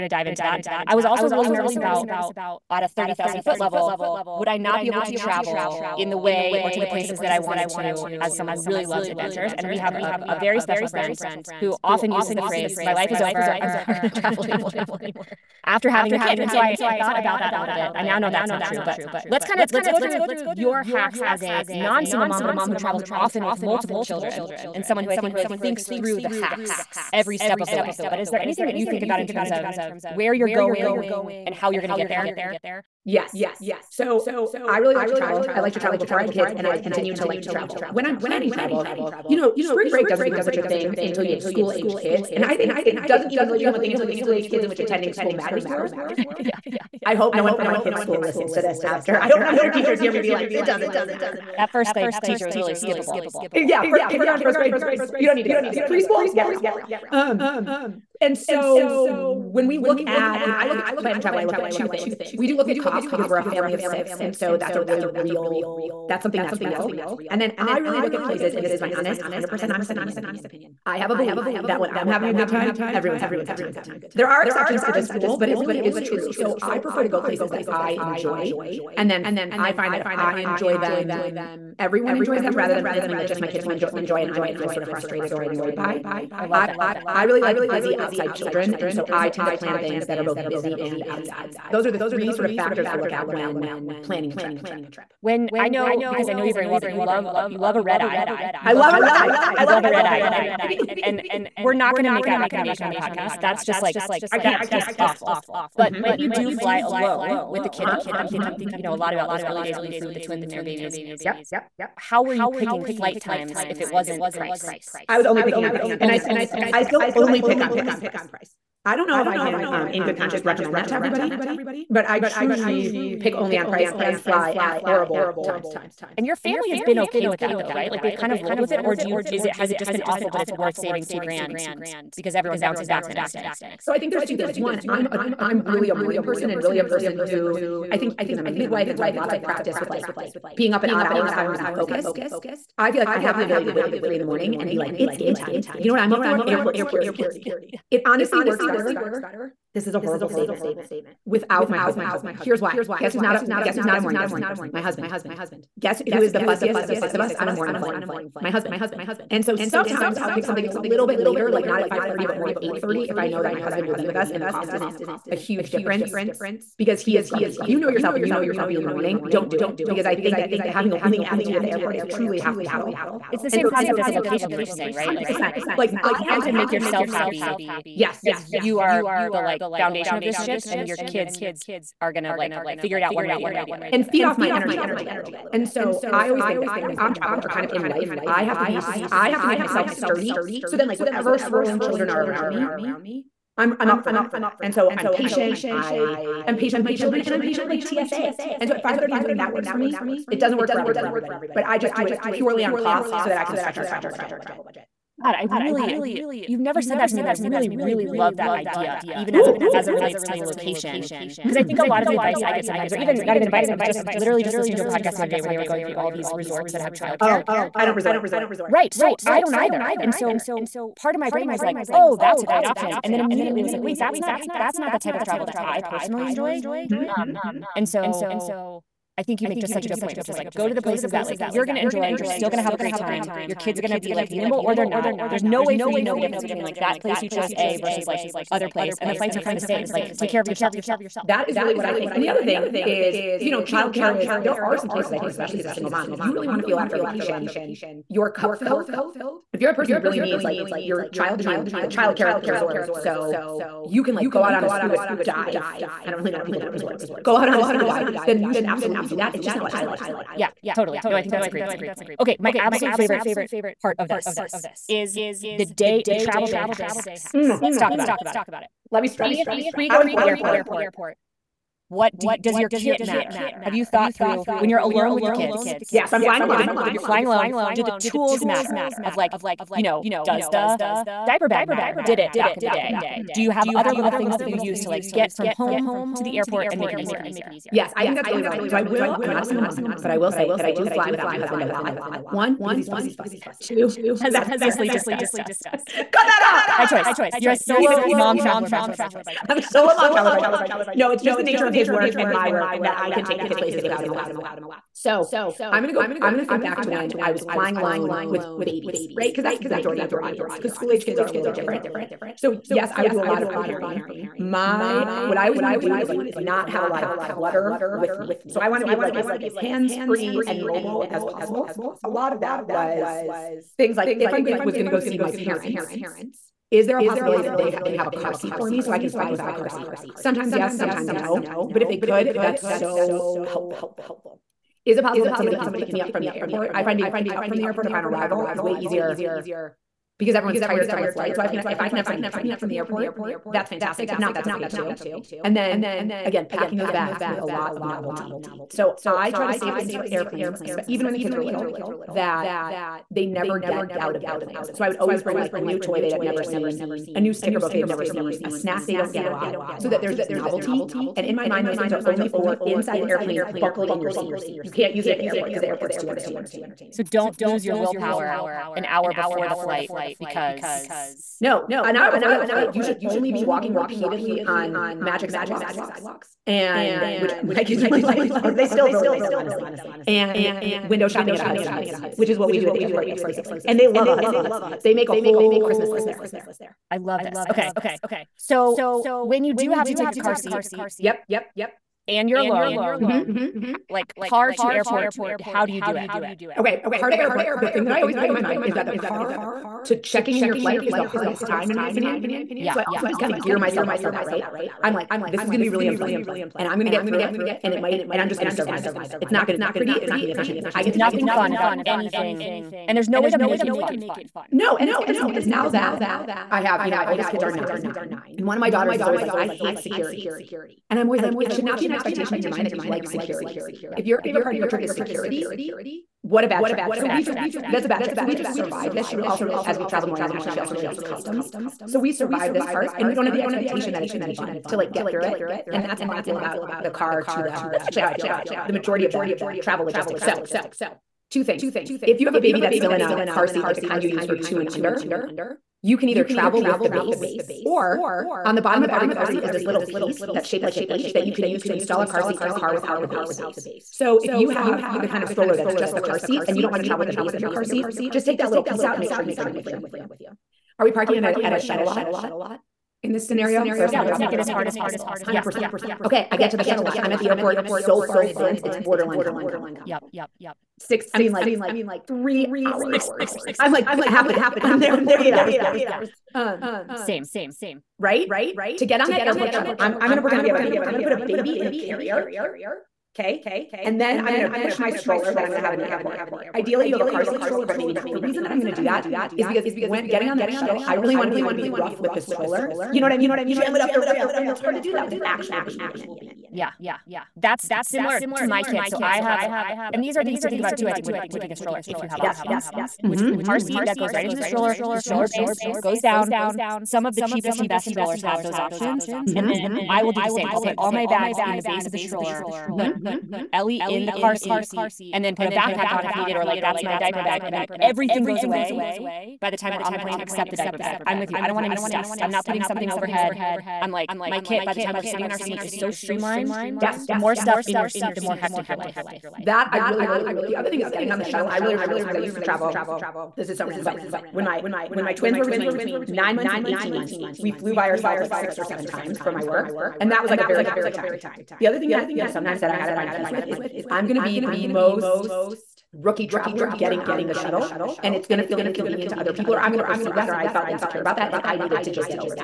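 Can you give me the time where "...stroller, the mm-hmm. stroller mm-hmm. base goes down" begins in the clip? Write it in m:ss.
8:24.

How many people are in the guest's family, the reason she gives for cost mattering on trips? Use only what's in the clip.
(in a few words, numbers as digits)
6.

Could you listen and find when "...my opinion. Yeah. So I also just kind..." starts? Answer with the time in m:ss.
6:41.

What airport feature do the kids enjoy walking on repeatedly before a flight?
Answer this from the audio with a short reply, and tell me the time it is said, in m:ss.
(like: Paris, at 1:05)
Magic sidewalks, at 6:14.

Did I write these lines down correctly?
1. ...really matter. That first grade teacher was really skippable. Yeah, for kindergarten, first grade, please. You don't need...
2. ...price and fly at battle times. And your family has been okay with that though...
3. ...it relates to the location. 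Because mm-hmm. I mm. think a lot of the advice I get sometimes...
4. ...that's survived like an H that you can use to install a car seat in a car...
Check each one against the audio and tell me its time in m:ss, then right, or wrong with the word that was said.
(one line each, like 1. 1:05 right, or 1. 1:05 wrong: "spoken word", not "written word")
1. 0:50 right
2. 2:03 wrong: "horrible", not "battle"
3. 3:29 right
4. 7:30 wrong: "shaped", not "survived".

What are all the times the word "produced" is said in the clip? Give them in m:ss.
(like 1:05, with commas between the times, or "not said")
not said.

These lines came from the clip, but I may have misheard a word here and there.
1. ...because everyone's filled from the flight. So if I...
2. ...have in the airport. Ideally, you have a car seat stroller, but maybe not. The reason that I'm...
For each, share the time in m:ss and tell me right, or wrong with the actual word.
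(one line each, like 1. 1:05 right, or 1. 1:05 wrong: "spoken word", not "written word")
1. 5:40 wrong: "tired", not "filled"
2. 8:05 right.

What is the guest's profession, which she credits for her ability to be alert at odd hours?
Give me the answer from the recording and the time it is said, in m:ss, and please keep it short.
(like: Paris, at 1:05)
Midwife, at 2:18.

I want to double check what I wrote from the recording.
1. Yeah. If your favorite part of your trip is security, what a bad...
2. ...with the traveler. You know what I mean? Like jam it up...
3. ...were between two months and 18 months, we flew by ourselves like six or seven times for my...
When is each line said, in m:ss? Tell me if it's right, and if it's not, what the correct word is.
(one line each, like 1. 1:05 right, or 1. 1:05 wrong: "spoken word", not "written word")
1. 7:03 right
2. 8:11 wrong: "stroller", not "traveler"
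3. 8:55 wrong: "nine", not "two".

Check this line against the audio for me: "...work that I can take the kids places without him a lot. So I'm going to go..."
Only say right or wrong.
right.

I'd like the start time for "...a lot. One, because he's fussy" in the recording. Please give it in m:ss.
4:51.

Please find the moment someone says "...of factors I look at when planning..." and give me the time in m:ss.
1:32.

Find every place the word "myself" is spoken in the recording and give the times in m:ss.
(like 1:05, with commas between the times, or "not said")
3:09, 6:43.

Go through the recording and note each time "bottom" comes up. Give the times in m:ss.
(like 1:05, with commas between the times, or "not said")
7:28.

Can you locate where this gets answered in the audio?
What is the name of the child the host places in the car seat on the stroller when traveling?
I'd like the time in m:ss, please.
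8:33.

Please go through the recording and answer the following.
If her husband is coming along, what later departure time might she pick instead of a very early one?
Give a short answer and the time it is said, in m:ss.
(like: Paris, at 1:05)
8:30, at 2:42.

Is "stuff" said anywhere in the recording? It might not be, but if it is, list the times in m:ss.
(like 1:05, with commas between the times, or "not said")
8:41, 8:47.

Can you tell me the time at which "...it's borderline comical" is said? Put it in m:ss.
7:48.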